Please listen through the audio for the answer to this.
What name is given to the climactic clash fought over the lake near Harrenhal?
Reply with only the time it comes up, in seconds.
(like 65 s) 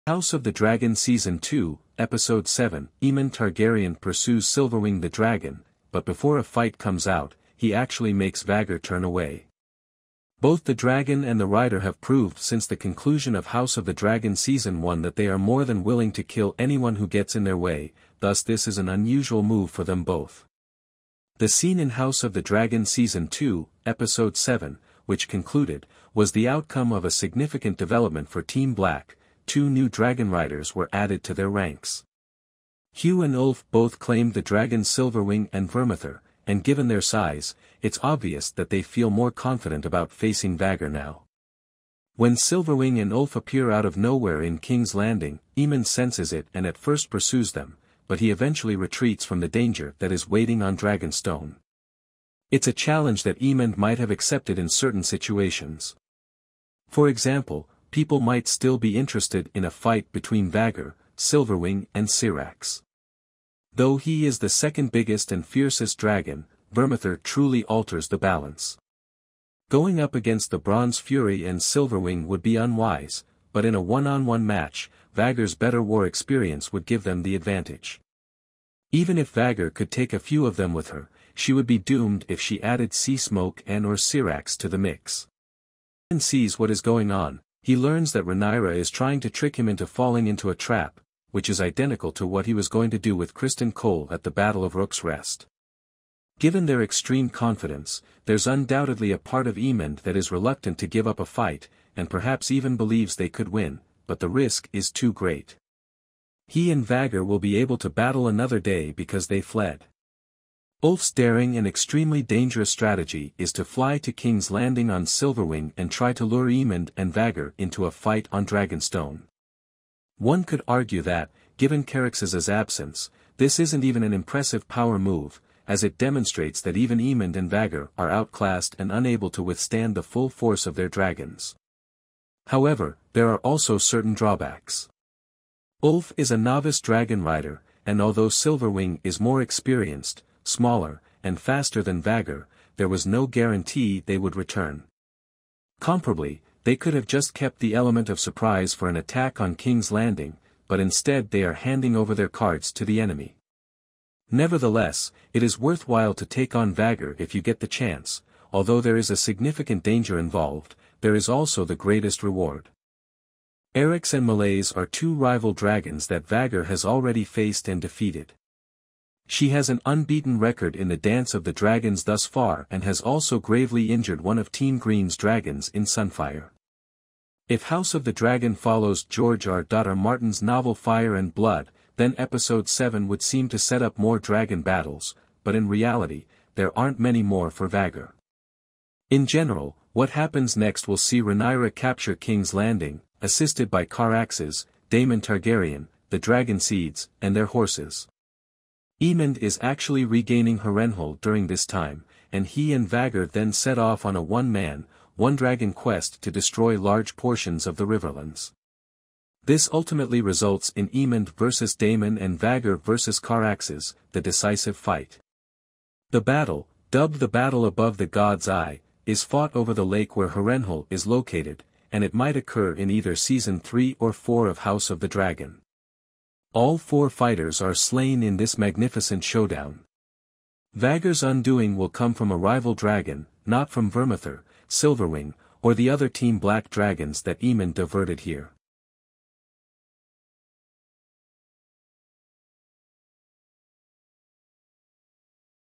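217 s.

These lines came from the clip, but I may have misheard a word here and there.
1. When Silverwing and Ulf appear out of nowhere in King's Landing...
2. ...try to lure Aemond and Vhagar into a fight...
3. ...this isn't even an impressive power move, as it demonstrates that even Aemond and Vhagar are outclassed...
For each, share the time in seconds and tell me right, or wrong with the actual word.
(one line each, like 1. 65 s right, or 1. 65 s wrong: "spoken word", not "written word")
1. 42 s right
2. 115 s right
3. 123 s right.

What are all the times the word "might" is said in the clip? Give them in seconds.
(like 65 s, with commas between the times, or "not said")
53 s, 58 s, 222 s.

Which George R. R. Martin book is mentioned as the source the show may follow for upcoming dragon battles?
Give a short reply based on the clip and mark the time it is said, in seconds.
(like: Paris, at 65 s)
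Fire and Blood, at 180 s.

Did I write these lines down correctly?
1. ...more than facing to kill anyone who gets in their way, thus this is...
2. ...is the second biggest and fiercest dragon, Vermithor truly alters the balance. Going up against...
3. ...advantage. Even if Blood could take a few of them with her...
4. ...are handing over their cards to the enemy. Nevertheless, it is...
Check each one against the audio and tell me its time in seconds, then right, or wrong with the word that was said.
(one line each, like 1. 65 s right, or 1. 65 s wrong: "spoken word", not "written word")
1. 15 s wrong: "willing", not "facing"
2. 64 s right
3. 77 s wrong: "Vhagar", not "Blood"
4. 151 s right.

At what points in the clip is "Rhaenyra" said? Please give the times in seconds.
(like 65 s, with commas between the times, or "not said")
88 s, 191 s.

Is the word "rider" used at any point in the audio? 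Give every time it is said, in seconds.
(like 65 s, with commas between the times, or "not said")
11 s, 30 s, 137 s.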